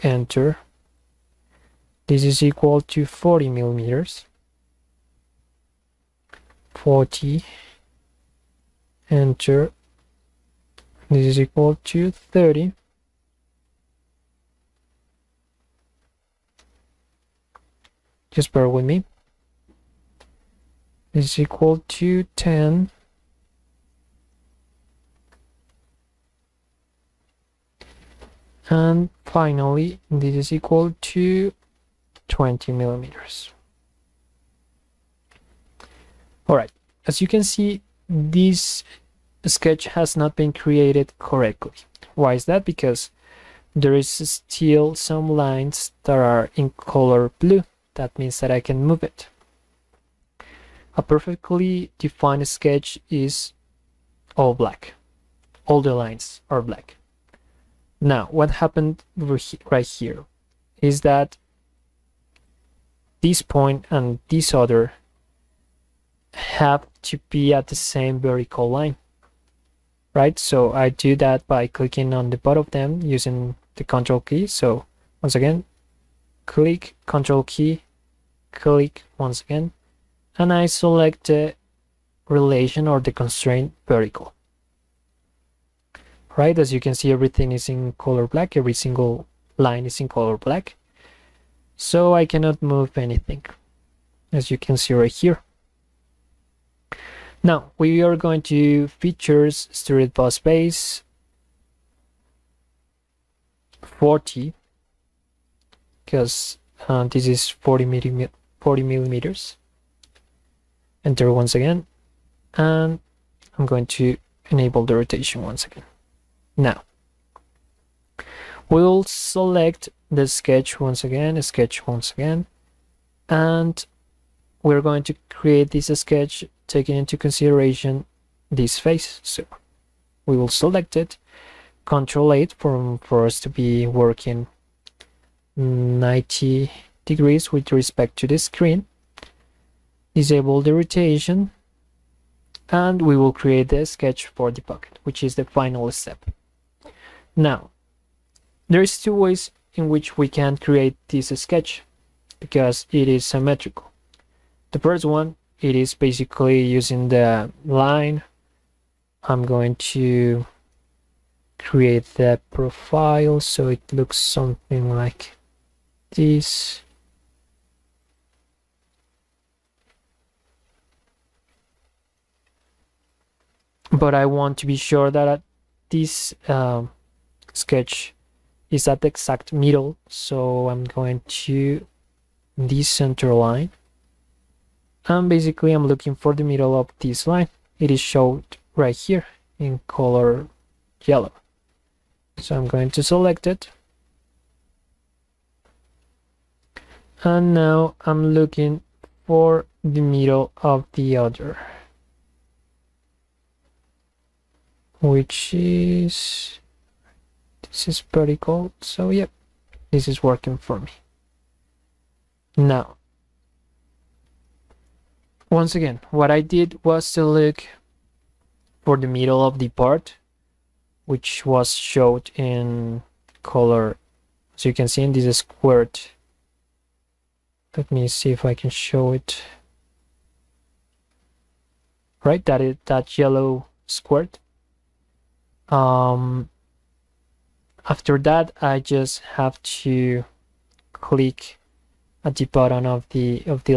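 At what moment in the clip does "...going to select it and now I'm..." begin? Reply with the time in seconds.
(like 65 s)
192 s.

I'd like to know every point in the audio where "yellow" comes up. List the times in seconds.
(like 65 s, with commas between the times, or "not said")
191 s, 233 s.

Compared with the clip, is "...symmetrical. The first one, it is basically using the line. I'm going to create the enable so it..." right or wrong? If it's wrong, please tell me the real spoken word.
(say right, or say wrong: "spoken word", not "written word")
wrong: "profile", not "enable".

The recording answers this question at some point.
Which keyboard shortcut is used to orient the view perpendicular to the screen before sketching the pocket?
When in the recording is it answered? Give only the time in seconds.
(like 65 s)
131 s.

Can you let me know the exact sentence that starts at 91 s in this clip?
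So I cannot move anything, as you can see right here.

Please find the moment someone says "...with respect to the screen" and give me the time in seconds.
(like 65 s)
137 s.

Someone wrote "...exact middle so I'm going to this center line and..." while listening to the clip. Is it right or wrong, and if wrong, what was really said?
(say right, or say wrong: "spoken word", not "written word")
right.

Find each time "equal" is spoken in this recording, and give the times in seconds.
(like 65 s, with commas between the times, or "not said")
2 s, 11 s, 21 s, 30 s.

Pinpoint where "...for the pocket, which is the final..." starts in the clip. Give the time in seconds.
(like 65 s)
144 s.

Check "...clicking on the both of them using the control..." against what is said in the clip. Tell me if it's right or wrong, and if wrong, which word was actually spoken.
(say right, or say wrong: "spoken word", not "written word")
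right.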